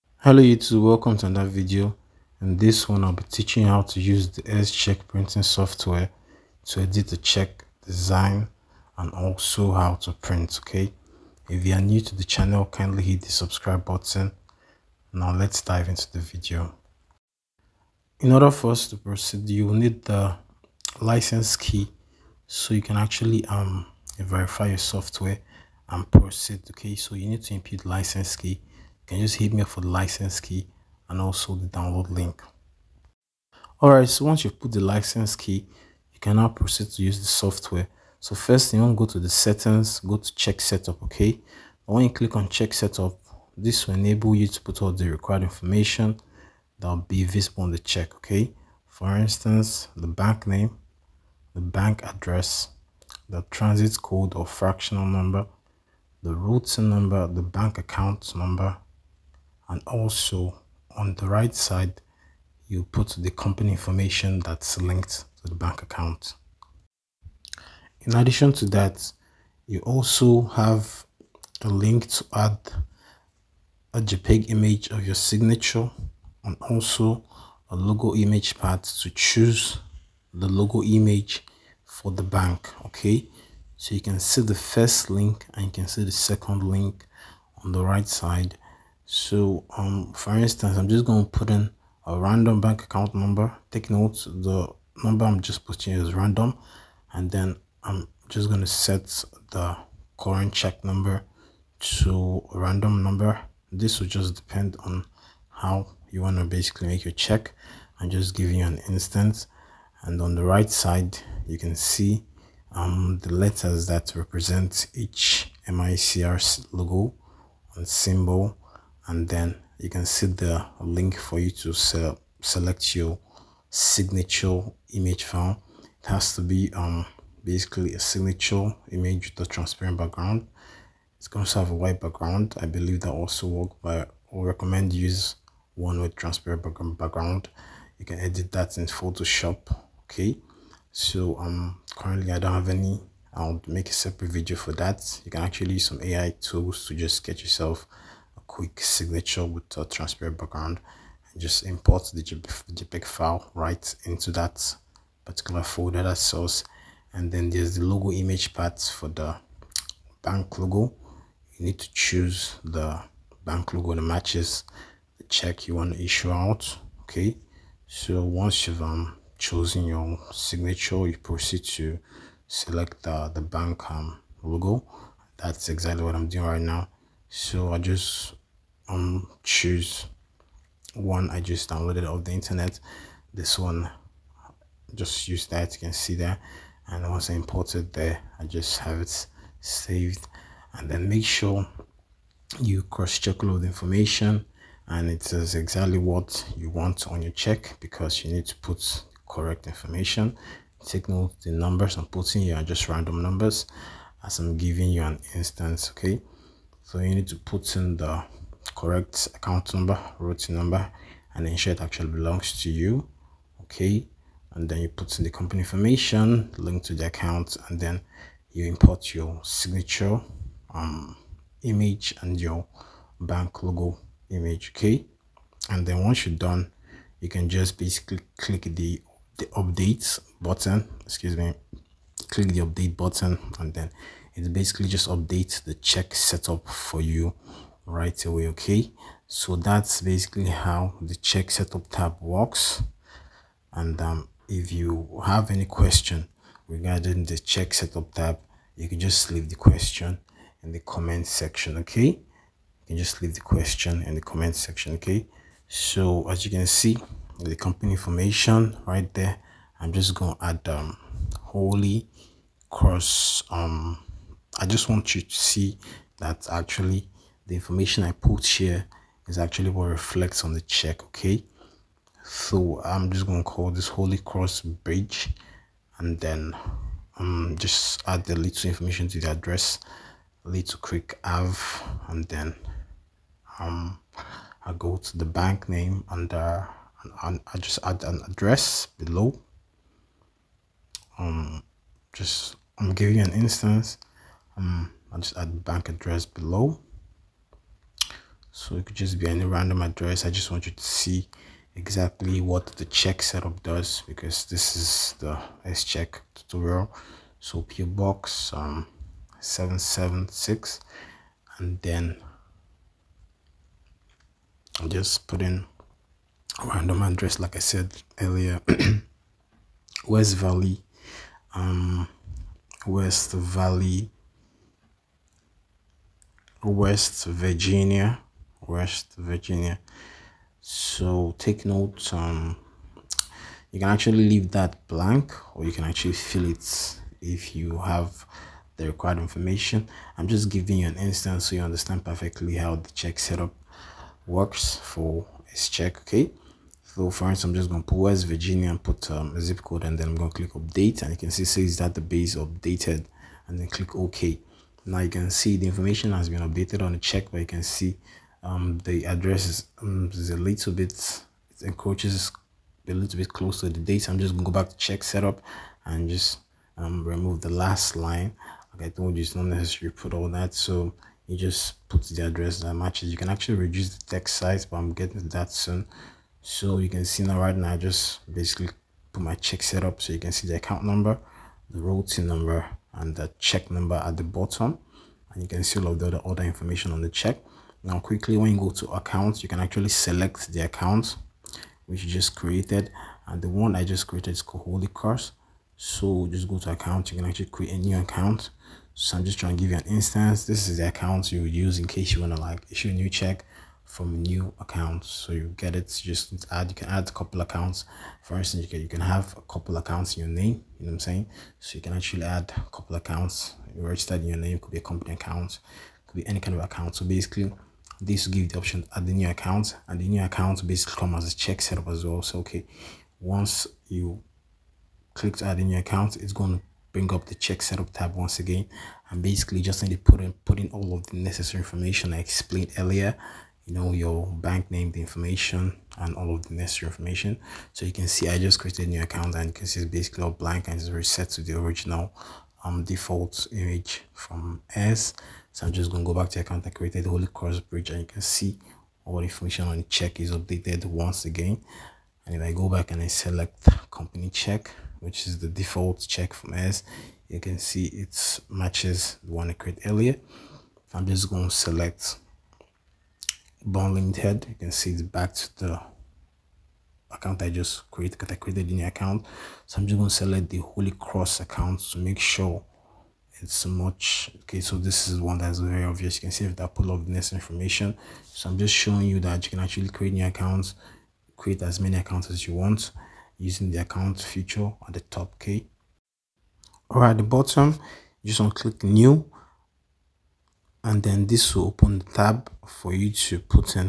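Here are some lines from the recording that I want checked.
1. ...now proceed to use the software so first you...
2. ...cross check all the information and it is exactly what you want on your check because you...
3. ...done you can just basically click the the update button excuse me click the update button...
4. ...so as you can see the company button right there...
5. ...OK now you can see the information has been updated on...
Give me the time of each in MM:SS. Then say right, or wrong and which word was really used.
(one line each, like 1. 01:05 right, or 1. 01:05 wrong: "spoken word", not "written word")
1. 00:36 right
2. 03:12 right
3. 03:46 right
4. 04:15 wrong: "information", not "button"
5. 05:53 right.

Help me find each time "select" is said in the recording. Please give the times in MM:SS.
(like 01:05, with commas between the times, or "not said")
02:02, 02:52, 06:29, 07:33, 07:41, 07:50.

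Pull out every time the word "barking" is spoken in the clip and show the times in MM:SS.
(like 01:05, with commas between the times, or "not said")
not said.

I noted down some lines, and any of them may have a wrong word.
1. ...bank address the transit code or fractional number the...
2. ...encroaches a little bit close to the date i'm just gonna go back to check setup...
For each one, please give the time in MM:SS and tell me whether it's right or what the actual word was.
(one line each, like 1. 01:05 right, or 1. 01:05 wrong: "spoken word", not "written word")
1. 00:51 right
2. 06:01 right.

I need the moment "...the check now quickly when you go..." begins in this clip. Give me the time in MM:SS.
06:27.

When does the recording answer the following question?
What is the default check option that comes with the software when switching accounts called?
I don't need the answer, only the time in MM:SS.
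07:33.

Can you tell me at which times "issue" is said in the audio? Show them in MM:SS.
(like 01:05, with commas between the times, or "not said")
02:46, 06:42.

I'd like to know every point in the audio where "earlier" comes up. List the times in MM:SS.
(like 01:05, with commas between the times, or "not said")
05:18, 07:12, 07:39.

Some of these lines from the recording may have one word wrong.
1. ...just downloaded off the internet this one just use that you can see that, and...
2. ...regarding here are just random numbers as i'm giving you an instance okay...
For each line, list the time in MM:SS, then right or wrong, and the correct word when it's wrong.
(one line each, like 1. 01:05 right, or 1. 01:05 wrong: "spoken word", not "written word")
1. 03:01 right
2. 03:22 wrong: "putting", not "regarding".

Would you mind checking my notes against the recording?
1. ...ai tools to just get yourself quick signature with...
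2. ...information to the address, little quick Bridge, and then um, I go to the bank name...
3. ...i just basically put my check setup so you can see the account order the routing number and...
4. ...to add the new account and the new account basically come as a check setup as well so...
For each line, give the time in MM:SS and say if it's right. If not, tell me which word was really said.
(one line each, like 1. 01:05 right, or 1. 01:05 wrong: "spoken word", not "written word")
1. 02:26 right
2. 04:38 wrong: "Ave", not "Bridge"
3. 06:17 wrong: "number", not "order"
4. 06:58 right.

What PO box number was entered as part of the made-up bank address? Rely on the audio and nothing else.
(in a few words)
776.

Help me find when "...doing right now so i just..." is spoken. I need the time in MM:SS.
02:56.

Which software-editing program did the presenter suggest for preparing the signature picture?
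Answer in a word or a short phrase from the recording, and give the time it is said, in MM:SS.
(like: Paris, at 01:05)
Photoshop, at 02:18.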